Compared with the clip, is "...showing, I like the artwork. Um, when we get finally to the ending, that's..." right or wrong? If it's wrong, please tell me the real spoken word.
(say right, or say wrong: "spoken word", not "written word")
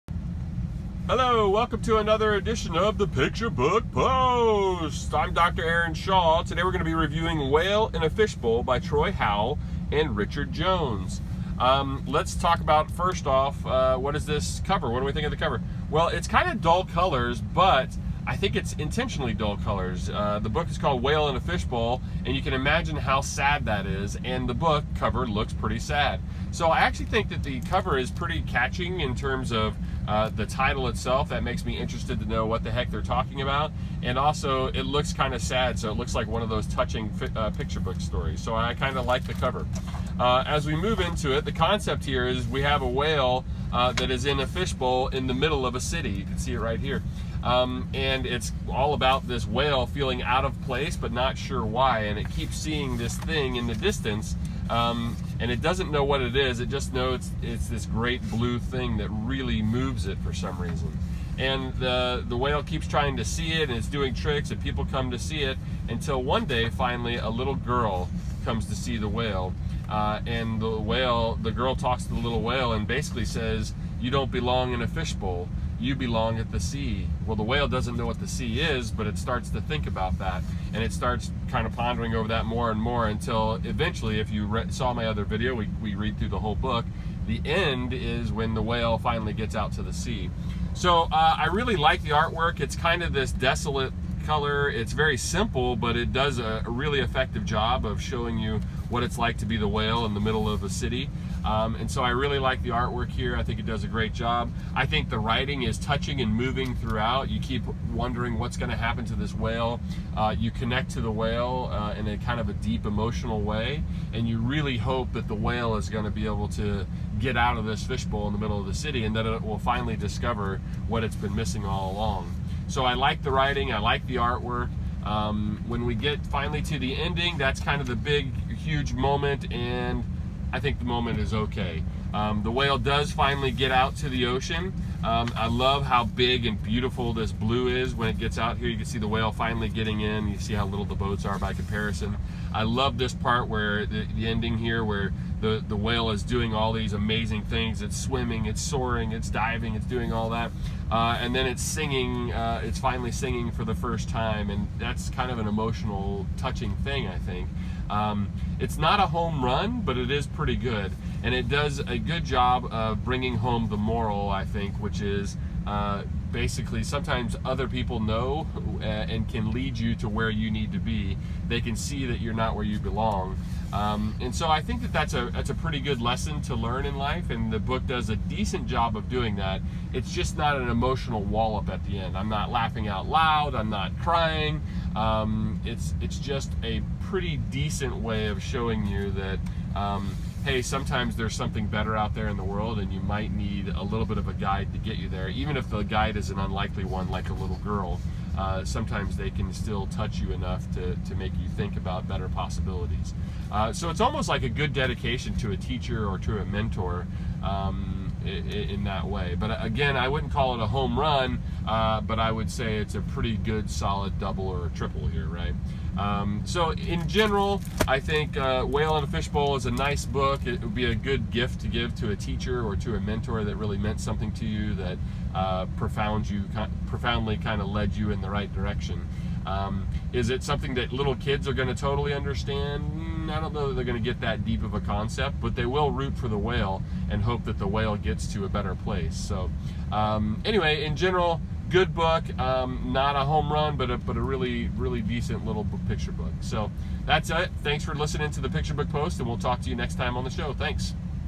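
wrong: "writing", not "showing".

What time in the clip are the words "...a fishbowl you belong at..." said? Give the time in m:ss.
1:14.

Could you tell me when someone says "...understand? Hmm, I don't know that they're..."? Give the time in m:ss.
3:52.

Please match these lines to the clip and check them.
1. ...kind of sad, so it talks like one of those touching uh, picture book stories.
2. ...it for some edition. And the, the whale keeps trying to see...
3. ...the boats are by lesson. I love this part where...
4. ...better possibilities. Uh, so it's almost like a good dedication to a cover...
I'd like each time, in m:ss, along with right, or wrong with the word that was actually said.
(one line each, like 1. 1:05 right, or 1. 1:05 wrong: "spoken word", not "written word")
1. 0:35 wrong: "looks", not "talks"
2. 1:00 wrong: "reason", not "edition"
3. 2:20 wrong: "comparison", not "lesson"
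4. 3:22 wrong: "teacher", not "cover".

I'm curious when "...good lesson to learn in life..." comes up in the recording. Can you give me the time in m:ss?
2:55.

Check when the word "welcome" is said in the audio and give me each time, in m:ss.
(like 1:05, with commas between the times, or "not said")
0:01.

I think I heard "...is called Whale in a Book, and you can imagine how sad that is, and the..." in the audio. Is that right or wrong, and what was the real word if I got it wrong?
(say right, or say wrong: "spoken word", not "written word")
wrong: "Fishbowl", not "Book".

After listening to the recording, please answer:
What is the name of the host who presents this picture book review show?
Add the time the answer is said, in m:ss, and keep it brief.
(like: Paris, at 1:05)
Dr. Aaron Shaw, at 0:05.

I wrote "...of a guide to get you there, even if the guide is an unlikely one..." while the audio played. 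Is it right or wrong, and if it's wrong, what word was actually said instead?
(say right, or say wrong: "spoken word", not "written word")
right.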